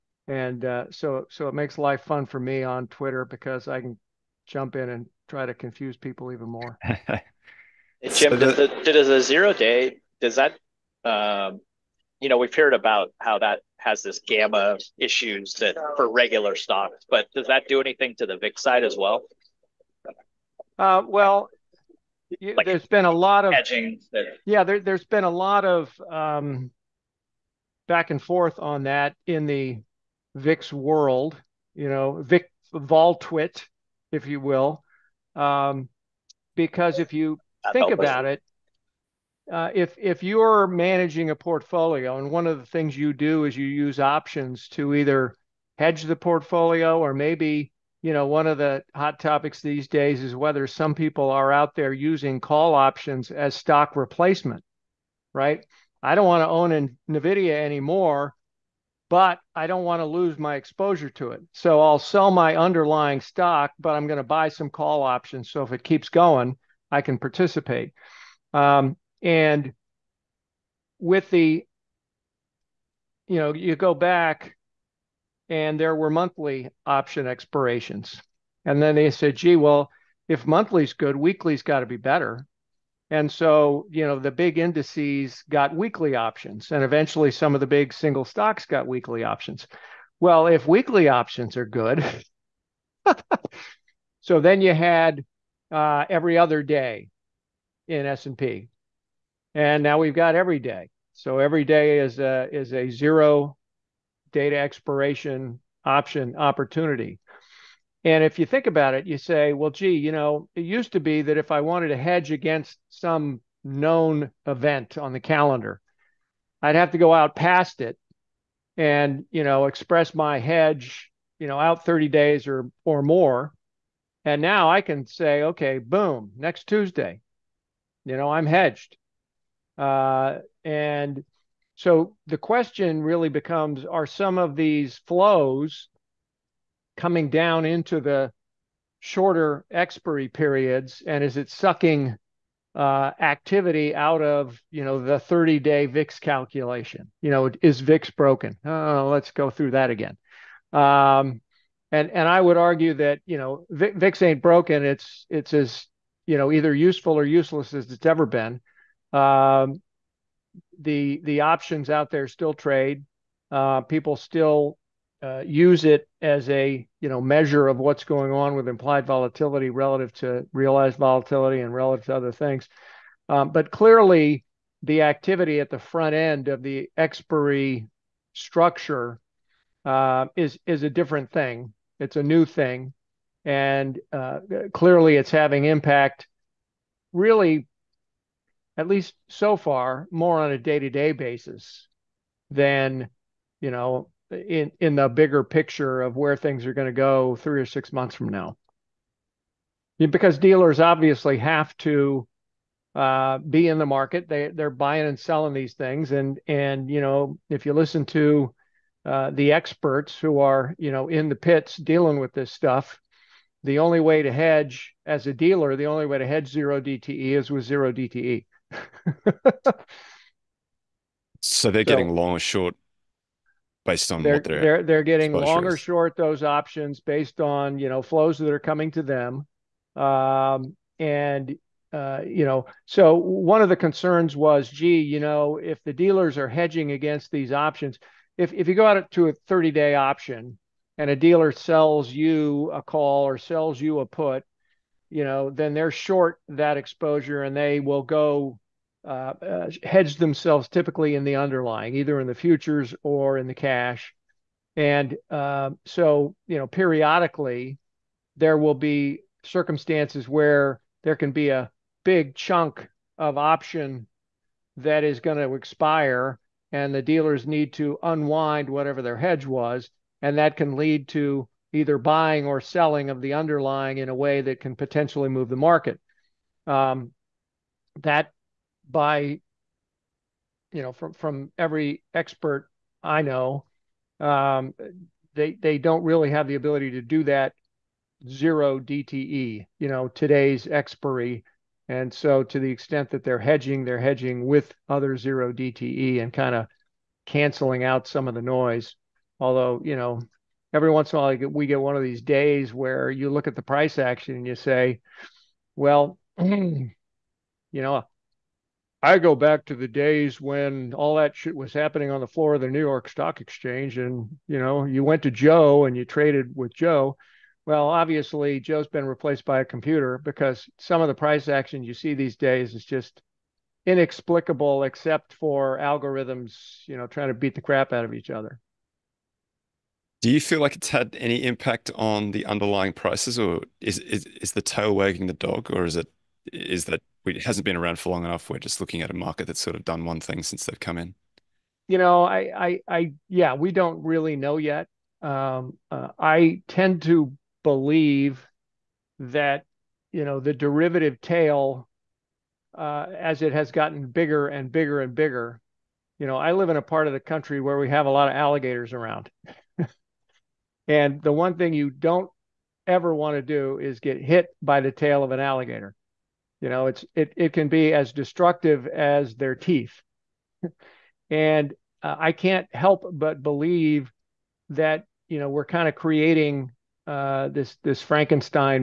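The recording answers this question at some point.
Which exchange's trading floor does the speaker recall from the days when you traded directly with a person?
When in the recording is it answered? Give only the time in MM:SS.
05:12.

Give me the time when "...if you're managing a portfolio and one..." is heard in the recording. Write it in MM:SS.
00:39.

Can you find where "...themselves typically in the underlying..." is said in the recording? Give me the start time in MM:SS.
04:10.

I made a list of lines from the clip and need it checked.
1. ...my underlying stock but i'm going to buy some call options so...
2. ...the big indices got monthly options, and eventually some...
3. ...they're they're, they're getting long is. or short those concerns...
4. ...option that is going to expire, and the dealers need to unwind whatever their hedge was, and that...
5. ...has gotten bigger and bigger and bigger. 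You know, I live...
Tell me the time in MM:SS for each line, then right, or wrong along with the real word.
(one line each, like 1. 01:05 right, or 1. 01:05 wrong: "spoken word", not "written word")
1. 01:02 right
2. 01:24 wrong: "weekly", not "monthly"
3. 03:44 wrong: "options", not "concerns"
4. 04:23 right
5. 05:53 right.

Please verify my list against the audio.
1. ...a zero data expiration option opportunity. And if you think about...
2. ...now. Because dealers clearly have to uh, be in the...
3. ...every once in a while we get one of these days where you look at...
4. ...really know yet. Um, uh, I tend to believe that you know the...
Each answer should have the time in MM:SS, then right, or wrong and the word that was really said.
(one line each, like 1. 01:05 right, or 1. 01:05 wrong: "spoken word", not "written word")
1. 01:42 right
2. 03:18 wrong: "obviously", not "clearly"
3. 05:00 right
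4. 05:44 right.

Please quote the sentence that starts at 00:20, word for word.
Uh, well, you, like there's been a lot of hedging.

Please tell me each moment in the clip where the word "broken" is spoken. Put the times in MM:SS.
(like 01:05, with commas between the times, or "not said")
02:28, 02:34.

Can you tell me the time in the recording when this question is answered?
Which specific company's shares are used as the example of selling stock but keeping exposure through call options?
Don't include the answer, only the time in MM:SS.
00:57.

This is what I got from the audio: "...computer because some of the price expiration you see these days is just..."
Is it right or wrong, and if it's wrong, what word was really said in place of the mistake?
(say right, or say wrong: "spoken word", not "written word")
wrong: "action", not "expiration".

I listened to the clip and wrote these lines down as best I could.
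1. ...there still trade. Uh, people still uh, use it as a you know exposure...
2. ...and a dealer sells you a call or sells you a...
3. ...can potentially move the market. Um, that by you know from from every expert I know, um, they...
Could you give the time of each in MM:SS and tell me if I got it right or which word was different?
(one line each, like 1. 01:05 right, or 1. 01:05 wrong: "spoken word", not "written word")
1. 02:42 wrong: "measure", not "exposure"
2. 04:00 right
3. 04:34 right.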